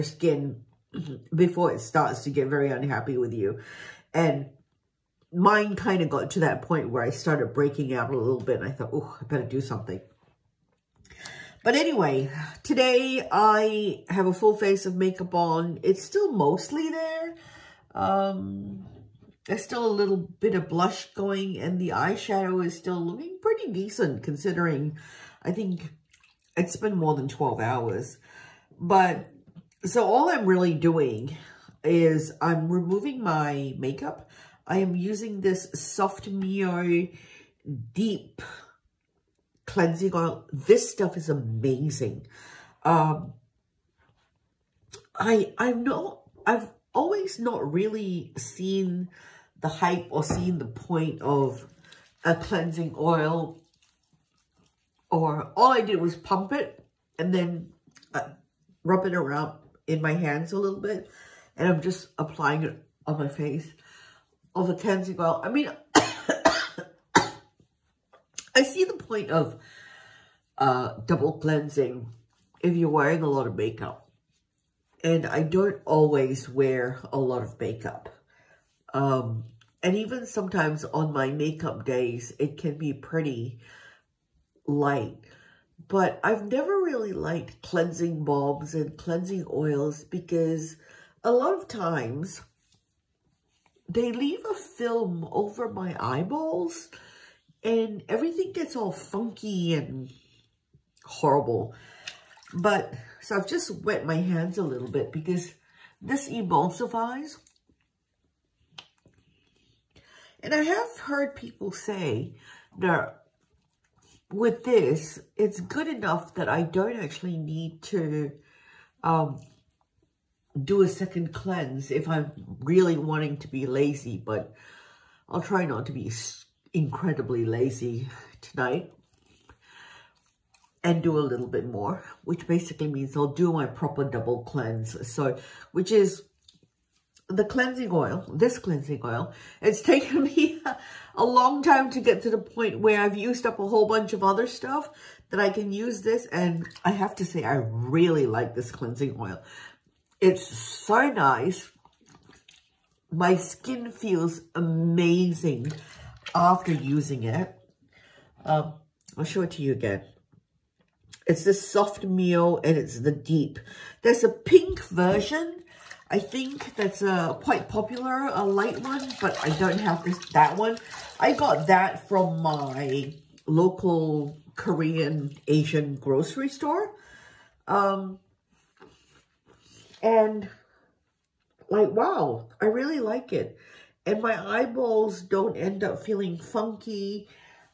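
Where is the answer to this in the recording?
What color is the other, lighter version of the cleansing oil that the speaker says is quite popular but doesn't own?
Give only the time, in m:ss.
2:44.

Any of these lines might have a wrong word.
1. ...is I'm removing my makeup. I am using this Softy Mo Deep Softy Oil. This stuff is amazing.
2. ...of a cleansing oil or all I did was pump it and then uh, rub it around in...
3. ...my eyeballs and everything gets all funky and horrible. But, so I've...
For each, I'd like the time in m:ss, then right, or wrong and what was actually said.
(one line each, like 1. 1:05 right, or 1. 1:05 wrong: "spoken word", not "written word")
1. 0:31 wrong: "Cleansing", not "Softy"
2. 0:51 right
3. 1:35 right.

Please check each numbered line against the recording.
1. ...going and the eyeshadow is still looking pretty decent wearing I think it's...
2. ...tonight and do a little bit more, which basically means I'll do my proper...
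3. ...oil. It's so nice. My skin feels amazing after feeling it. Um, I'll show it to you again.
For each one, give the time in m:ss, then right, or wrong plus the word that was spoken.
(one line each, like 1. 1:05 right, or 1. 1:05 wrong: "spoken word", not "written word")
1. 0:21 wrong: "considering", not "wearing"
2. 2:08 right
3. 2:29 wrong: "using", not "feeling".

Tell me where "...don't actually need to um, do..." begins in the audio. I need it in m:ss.
1:56.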